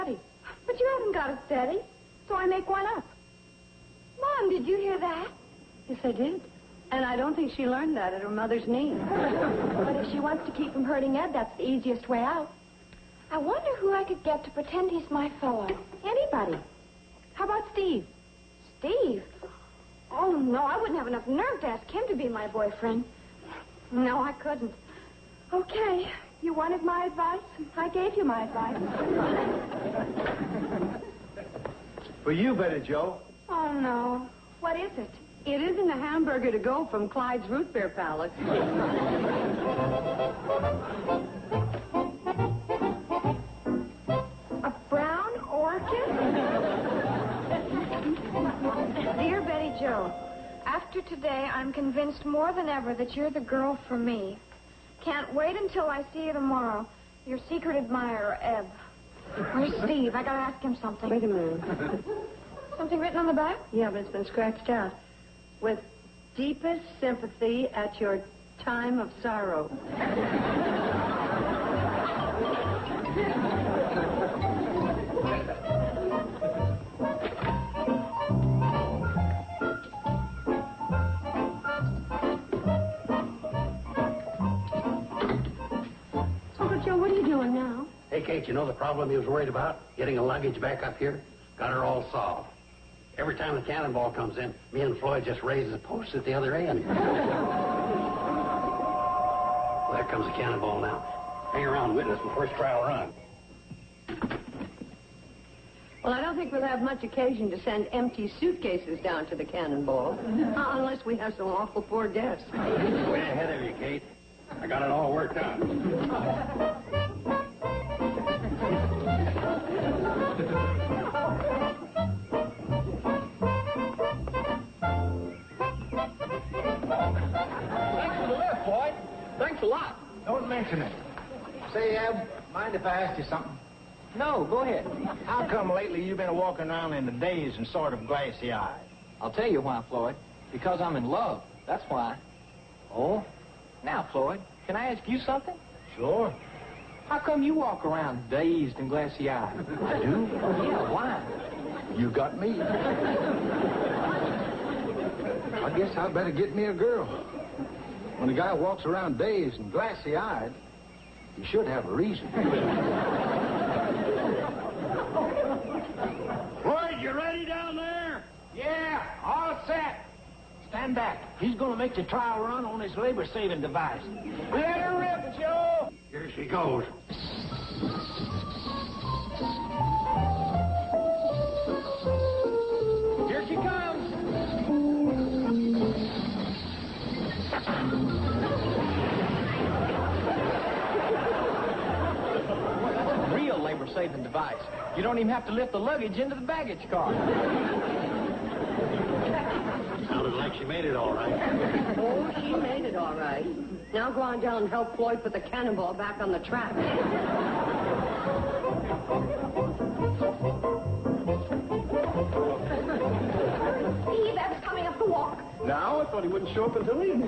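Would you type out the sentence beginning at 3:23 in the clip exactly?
Now go on down and help Floyd put the cannonball back on the track.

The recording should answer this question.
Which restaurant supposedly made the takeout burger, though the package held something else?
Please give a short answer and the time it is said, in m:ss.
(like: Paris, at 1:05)
Clyde's Root Beer Palace, at 0:37.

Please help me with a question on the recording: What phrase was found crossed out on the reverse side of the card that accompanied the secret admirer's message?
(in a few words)
With deepest sympathy at your time of sorrow.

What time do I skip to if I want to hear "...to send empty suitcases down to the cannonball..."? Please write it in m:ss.
1:47.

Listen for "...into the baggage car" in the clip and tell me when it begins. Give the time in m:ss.
3:16.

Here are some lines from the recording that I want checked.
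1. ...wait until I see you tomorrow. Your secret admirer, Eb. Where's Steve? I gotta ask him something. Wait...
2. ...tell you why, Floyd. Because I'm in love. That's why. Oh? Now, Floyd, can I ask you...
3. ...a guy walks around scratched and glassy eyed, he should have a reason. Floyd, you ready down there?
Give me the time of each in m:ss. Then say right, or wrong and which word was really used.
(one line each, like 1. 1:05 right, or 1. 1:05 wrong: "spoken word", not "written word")
1. 0:55 right
2. 2:19 right
3. 2:38 wrong: "dazed", not "scratched".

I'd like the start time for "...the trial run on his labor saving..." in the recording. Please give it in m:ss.
2:51.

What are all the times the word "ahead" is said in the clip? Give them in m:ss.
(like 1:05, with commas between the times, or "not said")
1:53, 2:14.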